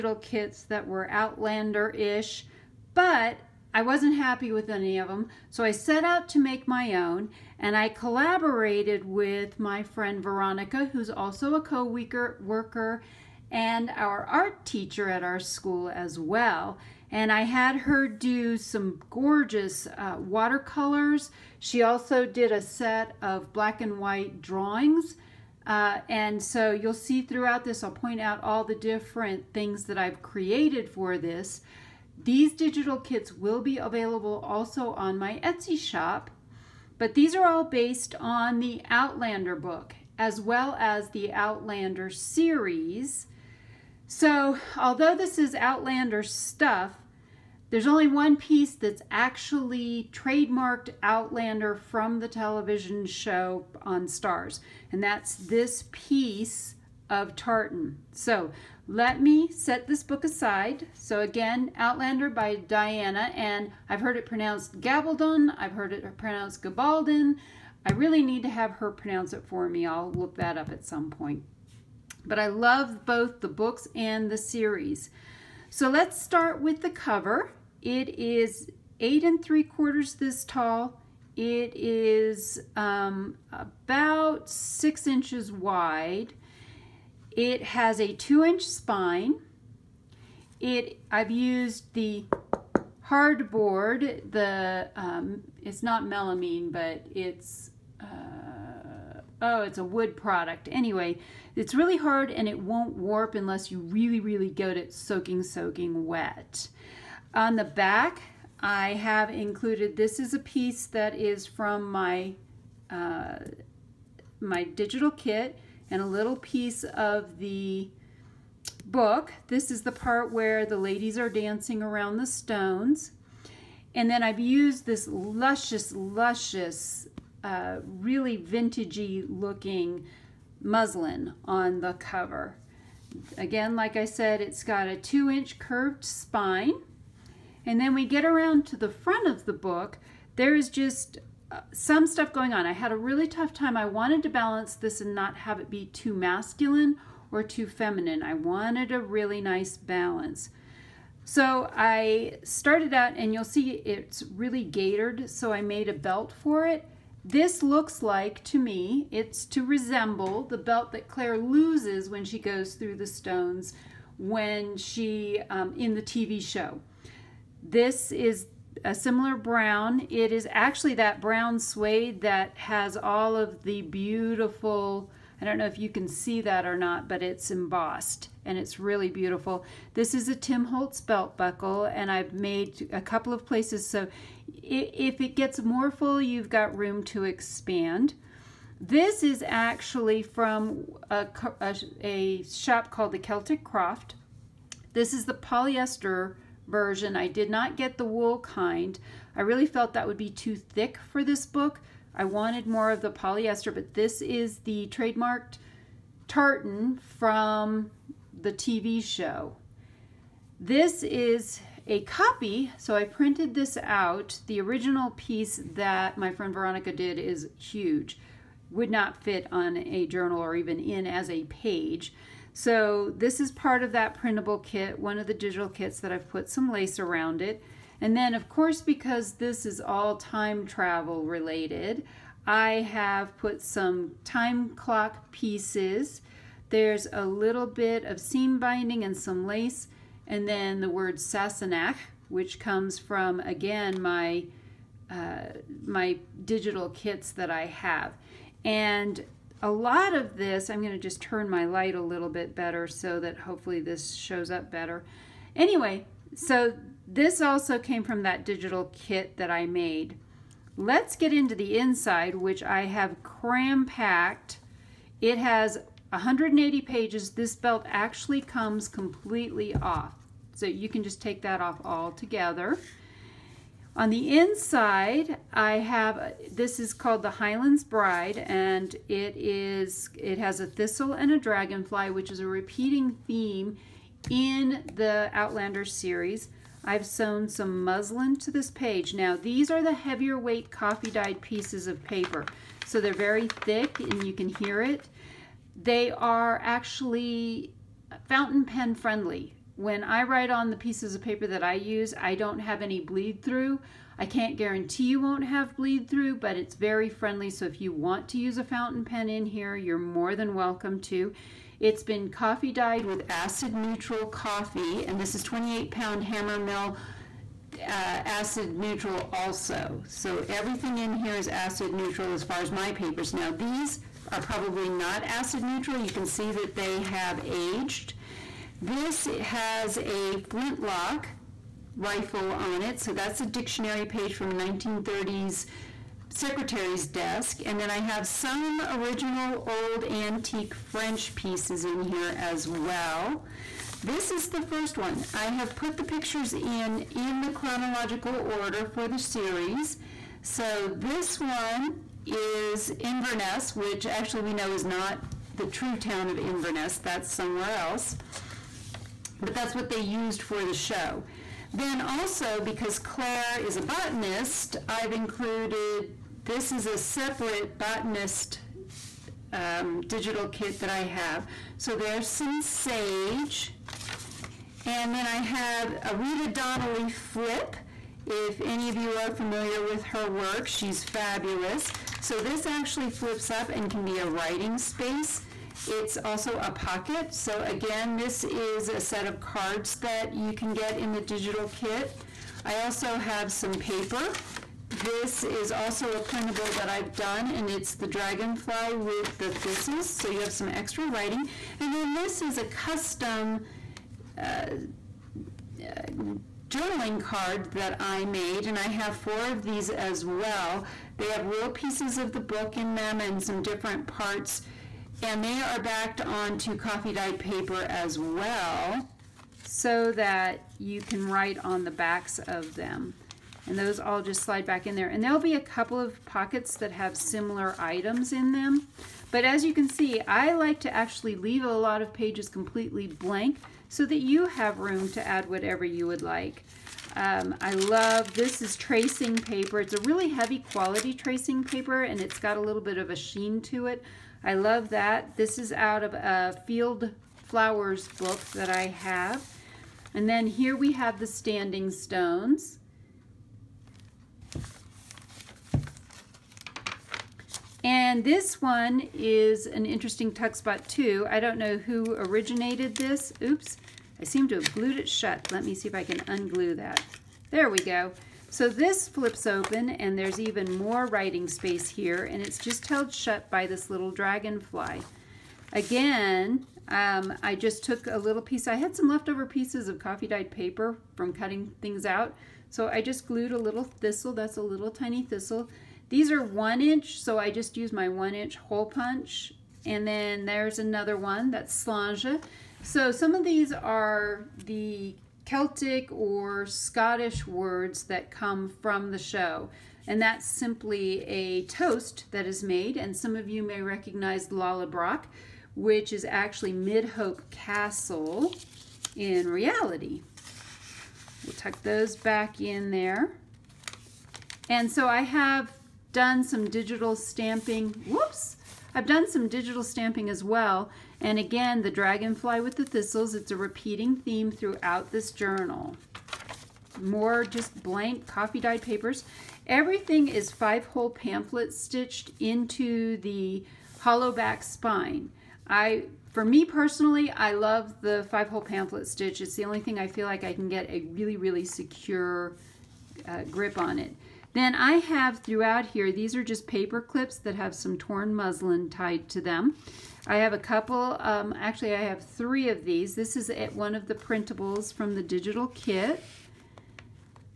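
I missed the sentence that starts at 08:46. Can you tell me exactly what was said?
More just blank coffee dyed papers.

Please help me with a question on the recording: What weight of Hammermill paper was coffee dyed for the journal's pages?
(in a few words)
28 pound.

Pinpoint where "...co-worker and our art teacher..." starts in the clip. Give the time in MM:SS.
00:11.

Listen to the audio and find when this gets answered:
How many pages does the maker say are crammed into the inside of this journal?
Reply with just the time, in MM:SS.
04:26.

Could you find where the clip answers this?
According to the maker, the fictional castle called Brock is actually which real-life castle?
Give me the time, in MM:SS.
08:26.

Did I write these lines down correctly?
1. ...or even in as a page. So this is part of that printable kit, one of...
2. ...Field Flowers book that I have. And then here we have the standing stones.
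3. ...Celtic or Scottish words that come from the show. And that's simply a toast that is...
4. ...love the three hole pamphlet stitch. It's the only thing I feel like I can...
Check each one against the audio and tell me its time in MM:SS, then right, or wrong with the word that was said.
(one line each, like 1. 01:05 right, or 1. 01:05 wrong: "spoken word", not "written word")
1. 03:40 right
2. 07:26 right
3. 08:15 right
4. 08:57 wrong: "five", not "three".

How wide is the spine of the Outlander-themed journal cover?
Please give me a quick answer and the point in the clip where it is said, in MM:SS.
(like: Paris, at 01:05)
2 inches, at 01:28.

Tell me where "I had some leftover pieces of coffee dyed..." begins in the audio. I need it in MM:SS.
07:58.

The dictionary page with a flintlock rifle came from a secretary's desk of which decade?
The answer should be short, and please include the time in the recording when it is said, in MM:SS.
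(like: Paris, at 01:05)
1930s, at 05:34.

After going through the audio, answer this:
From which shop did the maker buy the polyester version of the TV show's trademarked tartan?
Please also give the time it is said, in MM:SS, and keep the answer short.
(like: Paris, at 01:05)
Celtic Croft, at 03:13.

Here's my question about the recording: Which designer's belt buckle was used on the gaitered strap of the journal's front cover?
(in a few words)
Tim Holtz.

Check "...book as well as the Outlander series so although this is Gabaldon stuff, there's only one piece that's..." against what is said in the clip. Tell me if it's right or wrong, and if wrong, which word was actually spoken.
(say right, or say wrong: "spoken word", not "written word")
wrong: "Outlander", not "Gabaldon".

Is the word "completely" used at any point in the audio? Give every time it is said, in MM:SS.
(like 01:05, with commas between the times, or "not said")
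04:28, 07:12.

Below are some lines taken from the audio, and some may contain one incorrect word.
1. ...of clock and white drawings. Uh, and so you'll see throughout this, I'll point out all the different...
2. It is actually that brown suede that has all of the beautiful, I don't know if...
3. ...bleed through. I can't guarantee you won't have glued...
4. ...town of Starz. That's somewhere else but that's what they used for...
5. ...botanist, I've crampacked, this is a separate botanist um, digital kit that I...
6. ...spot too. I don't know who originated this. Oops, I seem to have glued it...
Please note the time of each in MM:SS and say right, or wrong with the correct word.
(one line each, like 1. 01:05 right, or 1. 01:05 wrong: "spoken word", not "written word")
1. 00:23 wrong: "black", not "clock"
2. 02:50 right
3. 05:02 wrong: "bleed", not "glued"
4. 05:55 wrong: "Inverness", not "Starz"
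5. 06:03 wrong: "included", not "crampacked"
6. 07:40 right.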